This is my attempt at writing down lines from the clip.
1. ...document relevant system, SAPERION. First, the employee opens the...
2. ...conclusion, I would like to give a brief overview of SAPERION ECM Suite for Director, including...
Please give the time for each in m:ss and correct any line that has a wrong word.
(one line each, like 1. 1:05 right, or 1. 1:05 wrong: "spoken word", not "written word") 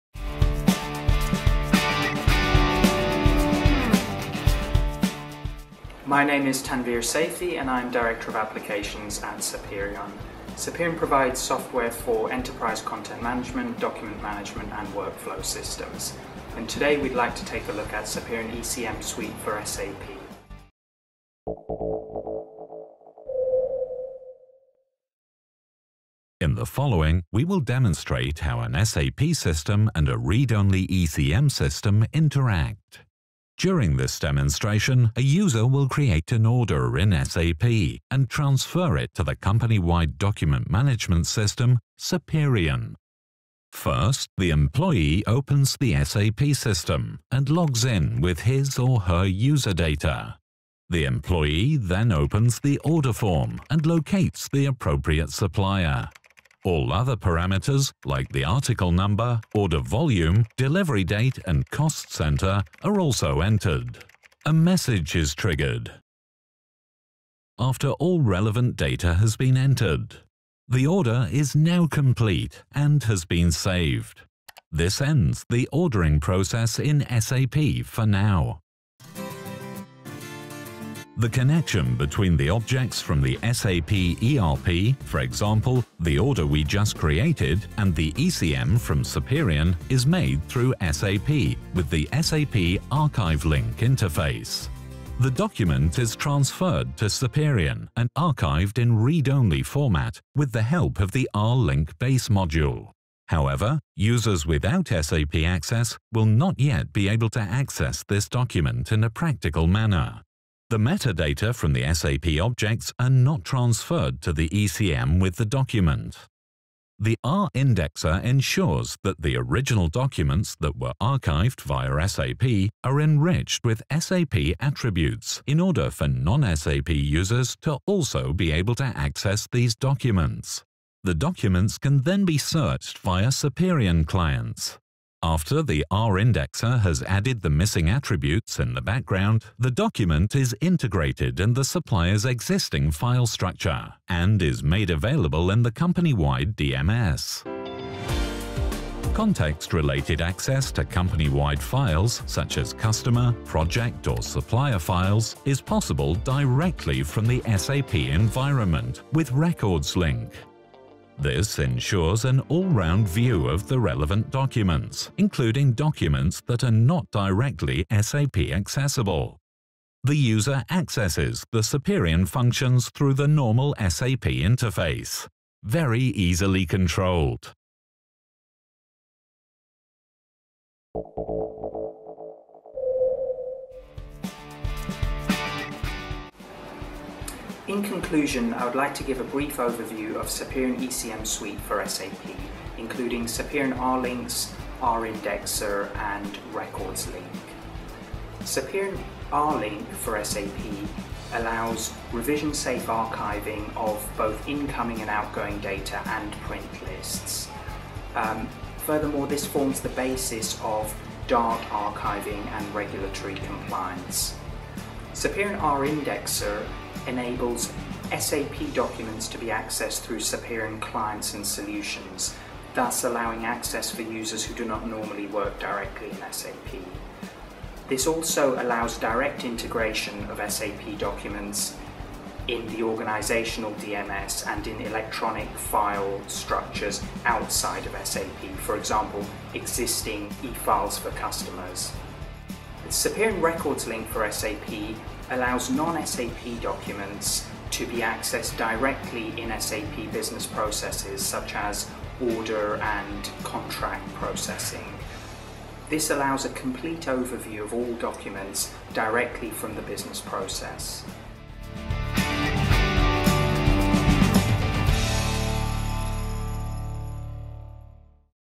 1. 0:40 wrong: "management", not "relevant"
2. 3:07 wrong: "SAP", not "Director".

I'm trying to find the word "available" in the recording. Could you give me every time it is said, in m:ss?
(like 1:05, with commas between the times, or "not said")
2:24.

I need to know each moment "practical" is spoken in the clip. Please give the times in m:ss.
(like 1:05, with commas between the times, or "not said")
1:49.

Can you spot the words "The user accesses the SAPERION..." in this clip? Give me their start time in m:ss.
2:50.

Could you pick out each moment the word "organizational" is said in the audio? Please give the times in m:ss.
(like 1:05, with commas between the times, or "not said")
3:52.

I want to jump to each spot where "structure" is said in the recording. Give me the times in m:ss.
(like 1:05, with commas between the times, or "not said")
2:23, 3:56.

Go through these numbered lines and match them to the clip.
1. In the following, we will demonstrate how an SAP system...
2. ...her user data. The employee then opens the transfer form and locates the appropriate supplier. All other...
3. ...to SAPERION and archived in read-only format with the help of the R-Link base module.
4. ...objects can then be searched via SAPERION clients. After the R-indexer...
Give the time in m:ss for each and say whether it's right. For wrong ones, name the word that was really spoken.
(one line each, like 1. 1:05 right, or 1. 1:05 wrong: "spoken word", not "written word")
1. 0:26 right
2. 0:49 wrong: "order", not "transfer"
3. 1:36 right
4. 2:11 wrong: "documents", not "objects".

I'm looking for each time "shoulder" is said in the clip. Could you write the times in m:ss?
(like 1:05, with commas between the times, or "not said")
not said.